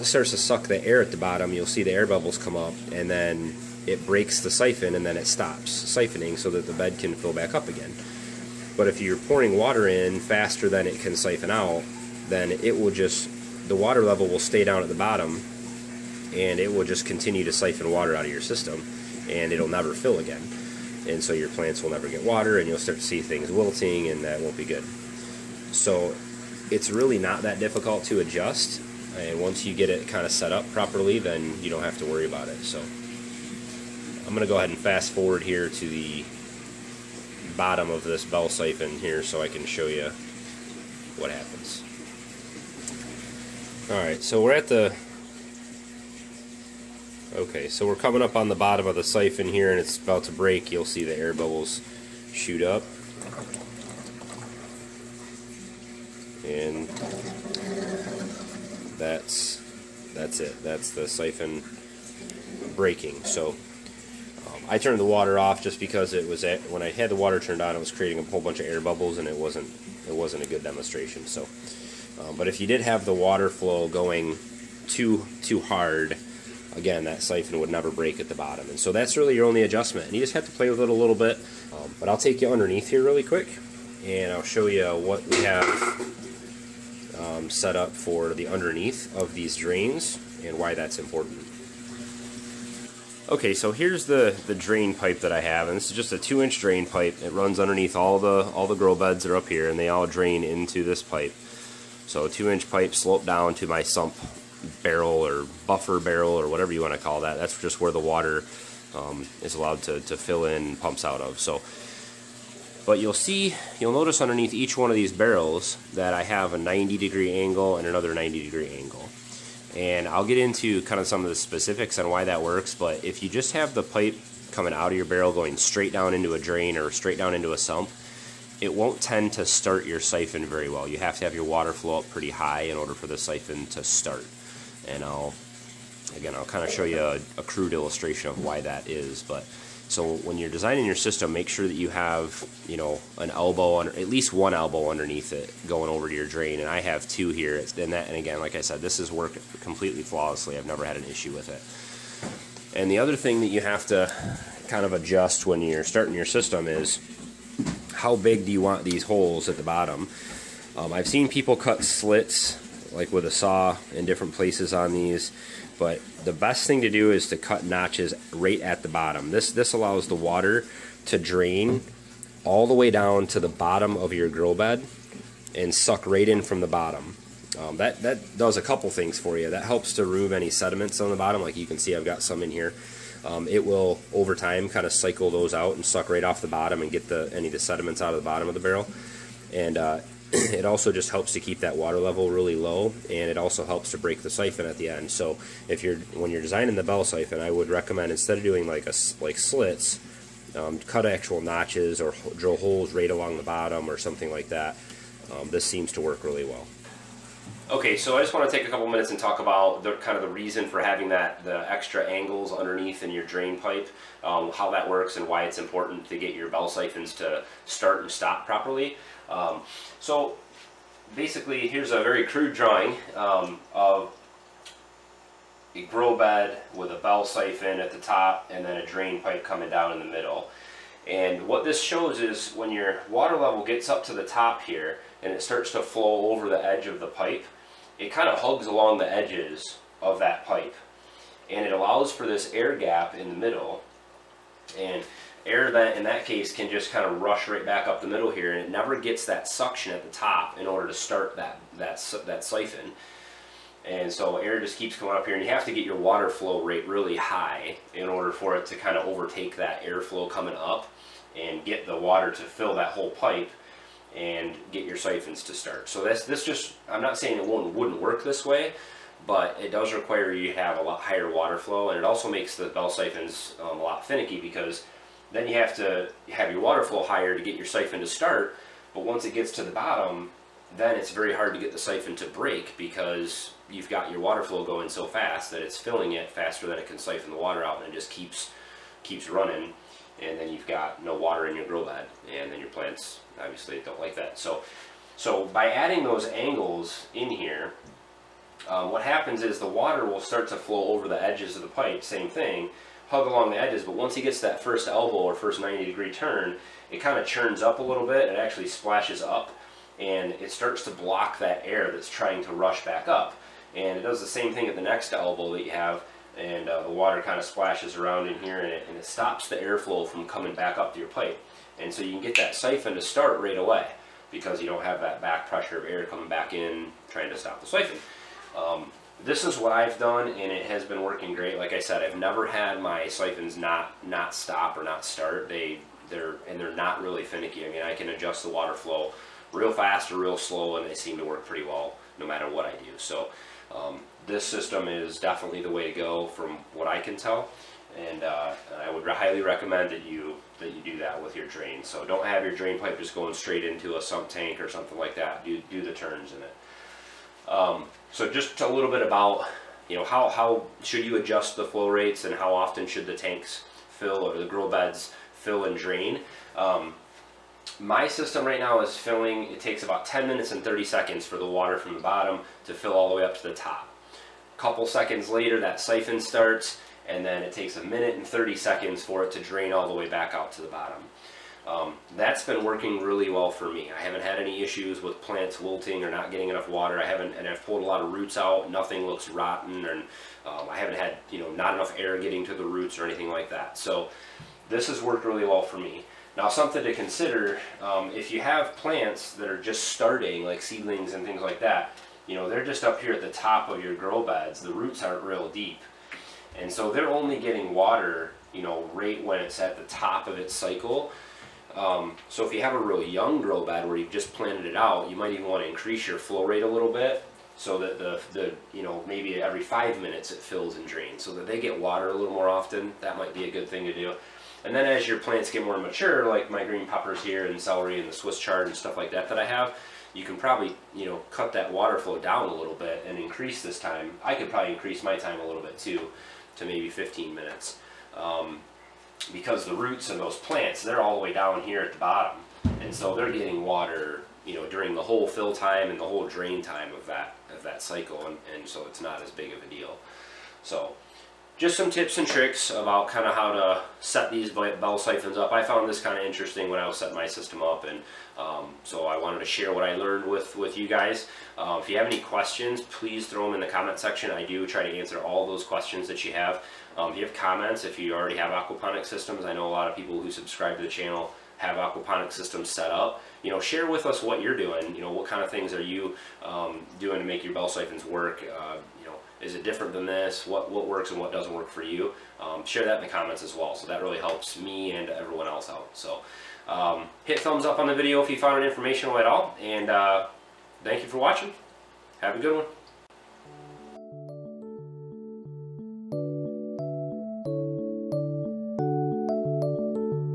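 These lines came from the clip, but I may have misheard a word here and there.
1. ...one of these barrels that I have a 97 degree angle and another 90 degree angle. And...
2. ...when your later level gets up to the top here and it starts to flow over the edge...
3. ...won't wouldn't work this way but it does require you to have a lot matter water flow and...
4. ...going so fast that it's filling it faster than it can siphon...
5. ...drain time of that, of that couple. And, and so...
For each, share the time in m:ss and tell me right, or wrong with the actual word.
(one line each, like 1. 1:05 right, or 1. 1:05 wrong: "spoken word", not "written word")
1. 1:54 wrong: "90", not "97"
2. 3:52 wrong: "water", not "later"
3. 4:27 wrong: "higher", not "matter"
4. 4:44 right
5. 7:26 wrong: "cycle", not "couple".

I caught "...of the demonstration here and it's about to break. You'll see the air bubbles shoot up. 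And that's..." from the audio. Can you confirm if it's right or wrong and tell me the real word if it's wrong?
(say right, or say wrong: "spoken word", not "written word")
wrong: "siphon", not "demonstration".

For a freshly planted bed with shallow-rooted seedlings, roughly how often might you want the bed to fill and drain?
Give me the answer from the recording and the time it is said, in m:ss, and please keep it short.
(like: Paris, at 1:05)
every 5 minutes, at 6:59.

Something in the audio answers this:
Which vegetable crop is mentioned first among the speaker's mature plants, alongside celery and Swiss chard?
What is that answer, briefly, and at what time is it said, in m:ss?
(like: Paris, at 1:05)
green peppers, at 7:06.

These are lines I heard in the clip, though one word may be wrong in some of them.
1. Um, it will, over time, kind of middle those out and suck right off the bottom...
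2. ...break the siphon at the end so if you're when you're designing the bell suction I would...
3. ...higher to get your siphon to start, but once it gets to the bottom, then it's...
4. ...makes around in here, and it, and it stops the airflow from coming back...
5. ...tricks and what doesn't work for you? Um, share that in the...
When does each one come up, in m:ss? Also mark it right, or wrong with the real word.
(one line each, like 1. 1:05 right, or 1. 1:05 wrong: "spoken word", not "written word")
1. 3:03 wrong: "cycle", not "middle"
2. 3:13 wrong: "siphon", not "suction"
3. 4:37 right
4. 5:17 wrong: "splashes", not "makes"
5. 8:00 wrong: "works", not "tricks".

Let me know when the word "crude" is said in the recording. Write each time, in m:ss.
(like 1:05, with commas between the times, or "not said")
2:17, 3:42.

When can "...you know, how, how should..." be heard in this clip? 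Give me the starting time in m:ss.
5:59.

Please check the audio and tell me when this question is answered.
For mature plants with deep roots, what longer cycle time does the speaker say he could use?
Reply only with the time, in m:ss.
7:16.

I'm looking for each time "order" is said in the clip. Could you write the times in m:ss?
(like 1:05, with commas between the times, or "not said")
2:12, 4:10, 4:18.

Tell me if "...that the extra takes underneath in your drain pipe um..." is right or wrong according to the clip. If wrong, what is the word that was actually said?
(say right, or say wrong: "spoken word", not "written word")
wrong: "angles", not "takes".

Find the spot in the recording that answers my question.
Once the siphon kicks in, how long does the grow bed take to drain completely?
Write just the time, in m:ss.
6:17.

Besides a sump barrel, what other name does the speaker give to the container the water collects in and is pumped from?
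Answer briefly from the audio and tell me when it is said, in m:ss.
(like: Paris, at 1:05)
buffer barrel, at 1:45.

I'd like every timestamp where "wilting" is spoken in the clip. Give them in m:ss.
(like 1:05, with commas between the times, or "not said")
0:23, 6:25.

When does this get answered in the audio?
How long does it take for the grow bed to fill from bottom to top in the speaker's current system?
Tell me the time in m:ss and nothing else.
6:10.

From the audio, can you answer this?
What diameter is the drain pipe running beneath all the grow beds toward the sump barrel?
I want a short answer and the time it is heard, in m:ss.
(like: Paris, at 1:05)
2 inch, at 1:36.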